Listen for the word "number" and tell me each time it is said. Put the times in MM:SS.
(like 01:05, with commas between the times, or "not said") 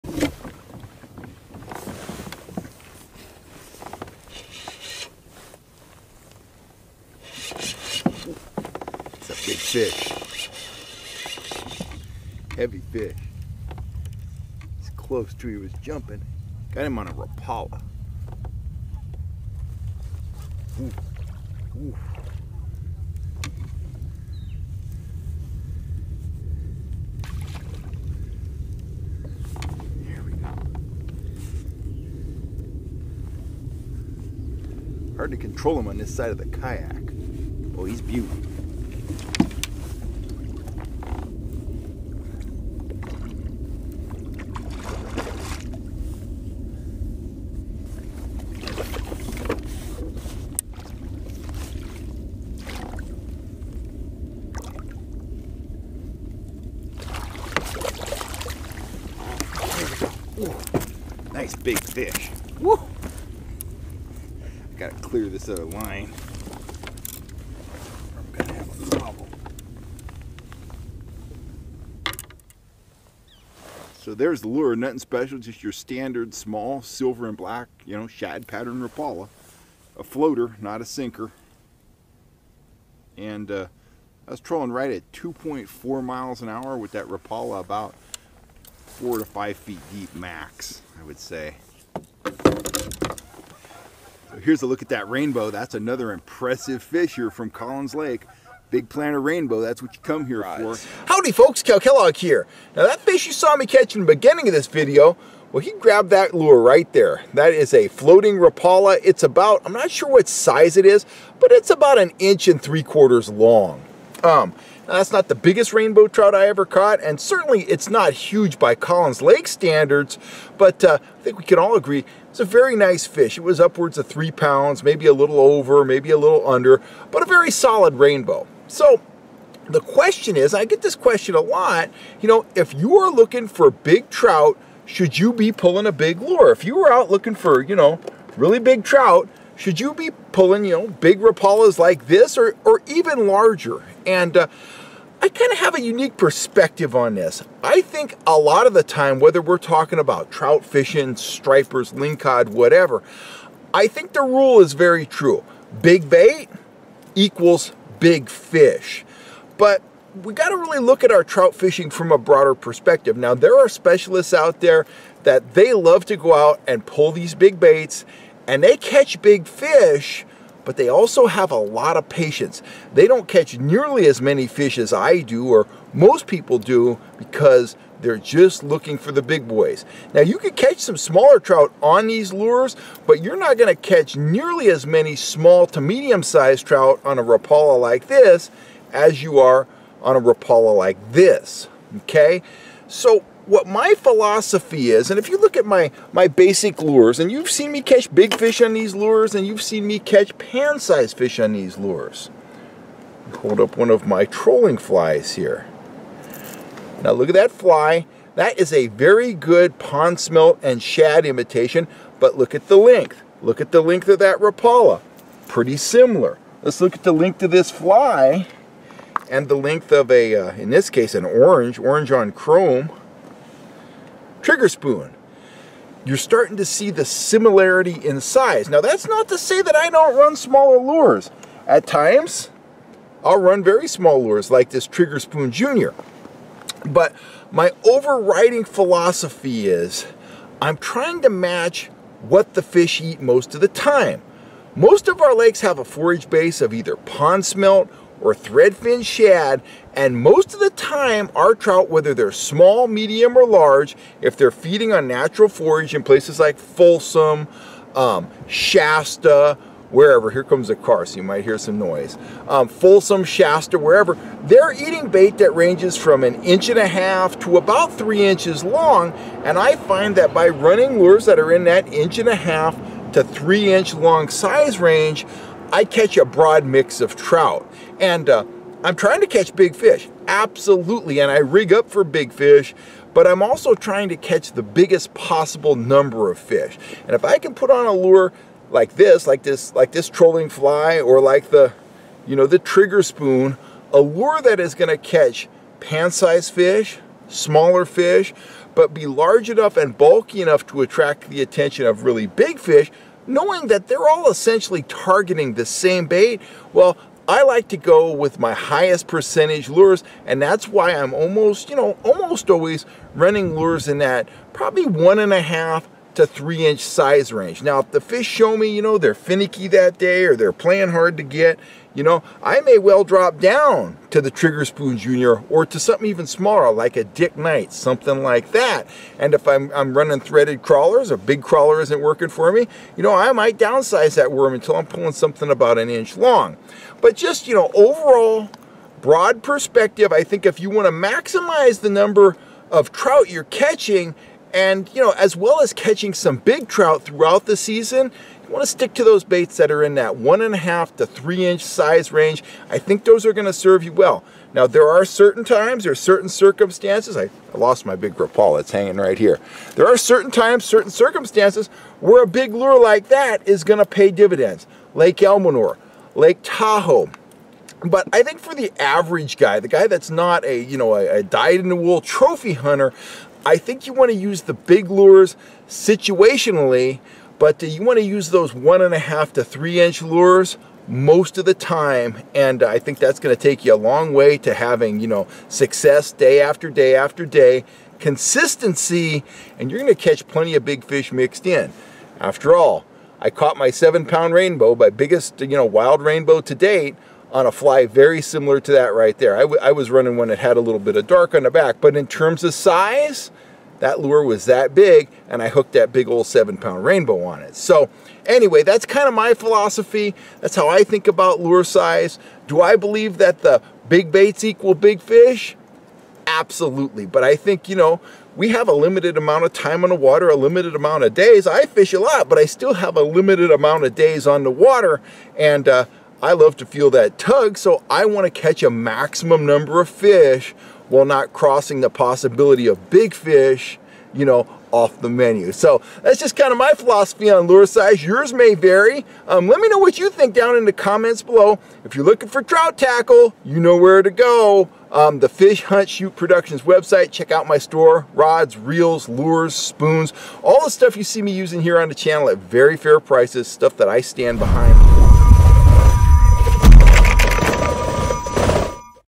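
04:45, 05:41, 07:09.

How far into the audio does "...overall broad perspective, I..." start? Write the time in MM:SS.
05:37.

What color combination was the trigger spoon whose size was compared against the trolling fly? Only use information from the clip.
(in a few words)
orange on chrome.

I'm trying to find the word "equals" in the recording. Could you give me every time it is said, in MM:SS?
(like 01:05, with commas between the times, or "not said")
02:37, 06:54.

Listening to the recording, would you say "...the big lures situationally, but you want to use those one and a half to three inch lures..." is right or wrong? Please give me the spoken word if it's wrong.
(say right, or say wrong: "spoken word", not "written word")
right.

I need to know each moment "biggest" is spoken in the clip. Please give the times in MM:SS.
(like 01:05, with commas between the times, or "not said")
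01:55, 04:44, 06:34.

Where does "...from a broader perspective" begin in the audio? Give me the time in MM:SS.
02:41.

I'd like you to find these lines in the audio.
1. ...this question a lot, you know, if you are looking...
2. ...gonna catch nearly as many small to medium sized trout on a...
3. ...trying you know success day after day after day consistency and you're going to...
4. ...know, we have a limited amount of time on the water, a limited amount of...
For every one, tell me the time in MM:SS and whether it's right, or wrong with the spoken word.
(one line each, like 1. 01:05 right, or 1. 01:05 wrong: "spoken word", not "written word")
1. 02:10 right
2. 03:03 right
3. 06:24 wrong: "having", not "trying"
4. 06:57 right.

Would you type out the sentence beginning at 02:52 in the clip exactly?
They don't catch nearly as many fish as I do or most people do because they're just looking for the big boys.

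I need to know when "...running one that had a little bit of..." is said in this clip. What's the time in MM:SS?
06:39.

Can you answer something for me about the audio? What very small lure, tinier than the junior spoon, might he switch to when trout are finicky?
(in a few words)
Dick Nite.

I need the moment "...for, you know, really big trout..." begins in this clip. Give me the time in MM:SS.
02:17.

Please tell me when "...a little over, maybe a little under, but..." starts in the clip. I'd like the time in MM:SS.
02:05.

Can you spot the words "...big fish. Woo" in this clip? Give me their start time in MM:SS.
01:01.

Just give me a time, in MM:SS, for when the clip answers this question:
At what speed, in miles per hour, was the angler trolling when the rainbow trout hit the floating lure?
01:25.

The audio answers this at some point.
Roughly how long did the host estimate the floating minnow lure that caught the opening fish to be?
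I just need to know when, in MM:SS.
01:51.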